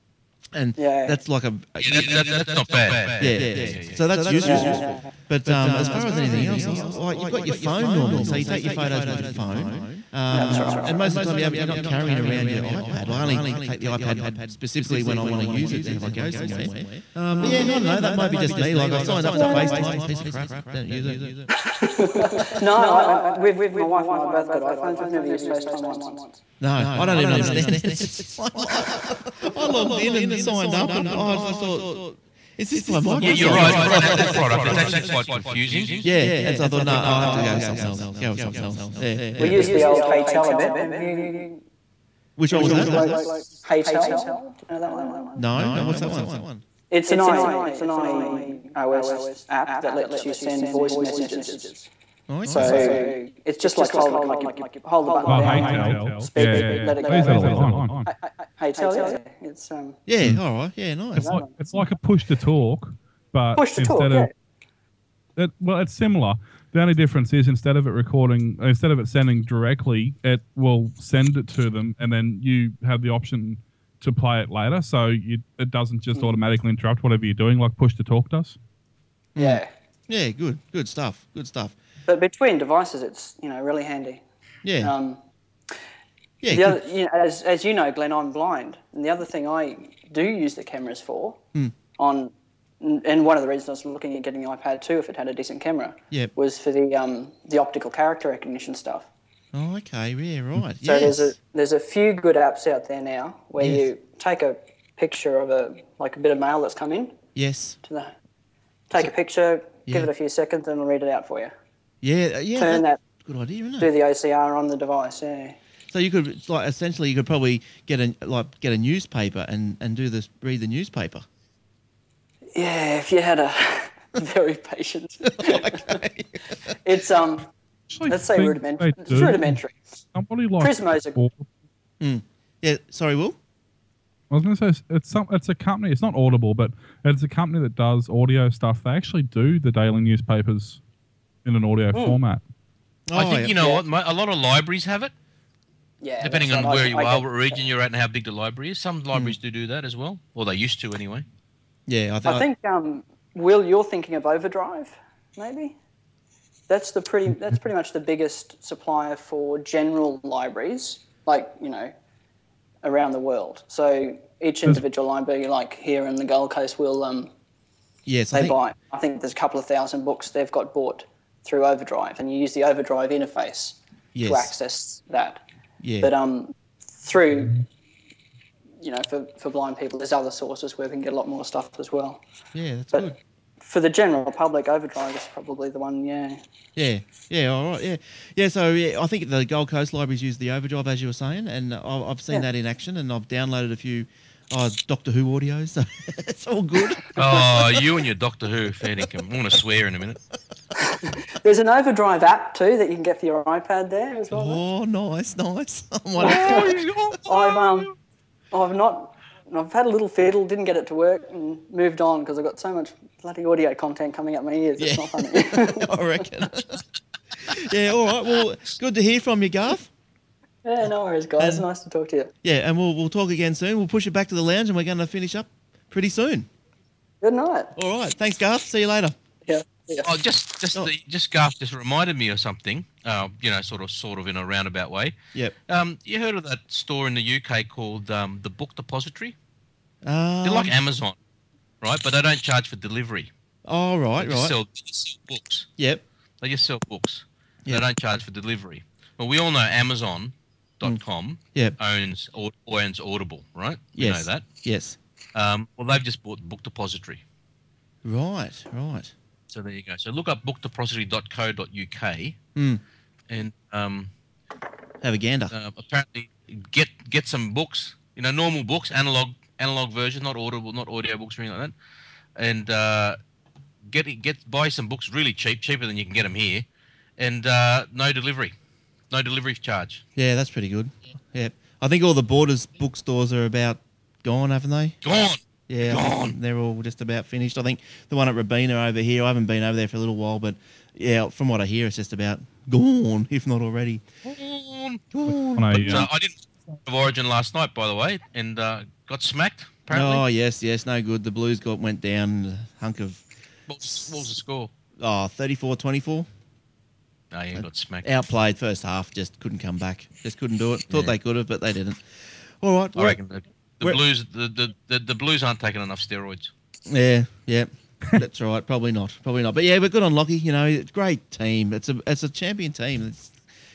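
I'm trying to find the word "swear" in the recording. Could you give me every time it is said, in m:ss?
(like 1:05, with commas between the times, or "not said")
3:19.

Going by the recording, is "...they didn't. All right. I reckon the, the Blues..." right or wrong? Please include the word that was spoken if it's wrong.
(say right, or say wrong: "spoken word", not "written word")
right.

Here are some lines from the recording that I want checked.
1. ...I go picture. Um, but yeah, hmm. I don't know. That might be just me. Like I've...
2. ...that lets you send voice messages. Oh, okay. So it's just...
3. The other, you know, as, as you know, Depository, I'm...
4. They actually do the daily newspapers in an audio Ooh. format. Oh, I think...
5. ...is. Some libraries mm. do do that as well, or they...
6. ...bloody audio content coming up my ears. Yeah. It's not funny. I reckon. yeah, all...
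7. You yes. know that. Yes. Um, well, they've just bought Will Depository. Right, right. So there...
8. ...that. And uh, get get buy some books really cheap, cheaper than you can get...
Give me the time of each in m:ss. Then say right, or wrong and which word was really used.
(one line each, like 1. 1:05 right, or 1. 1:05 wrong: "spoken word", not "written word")
1. 0:16 wrong: "somewhere", not "picture"
2. 0:49 right
3. 1:26 wrong: "Glenn", not "Depository"
4. 2:18 right
5. 2:28 right
6. 3:33 right
7. 4:13 wrong: "Book", not "Will"
8. 4:32 right.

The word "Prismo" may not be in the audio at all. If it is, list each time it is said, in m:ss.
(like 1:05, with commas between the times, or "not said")
2:10.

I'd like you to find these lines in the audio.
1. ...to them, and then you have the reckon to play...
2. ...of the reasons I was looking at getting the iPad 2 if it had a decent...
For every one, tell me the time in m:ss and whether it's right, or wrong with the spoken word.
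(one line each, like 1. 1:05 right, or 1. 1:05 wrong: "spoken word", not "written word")
1. 1:11 wrong: "option", not "reckon"
2. 1:33 right.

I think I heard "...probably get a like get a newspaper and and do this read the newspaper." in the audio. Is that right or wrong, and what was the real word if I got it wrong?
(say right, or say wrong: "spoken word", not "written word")
right.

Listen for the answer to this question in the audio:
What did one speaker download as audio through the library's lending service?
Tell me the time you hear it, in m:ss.
3:14.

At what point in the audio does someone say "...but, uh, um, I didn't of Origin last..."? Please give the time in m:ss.
4:55.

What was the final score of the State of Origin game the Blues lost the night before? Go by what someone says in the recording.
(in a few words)
34-24.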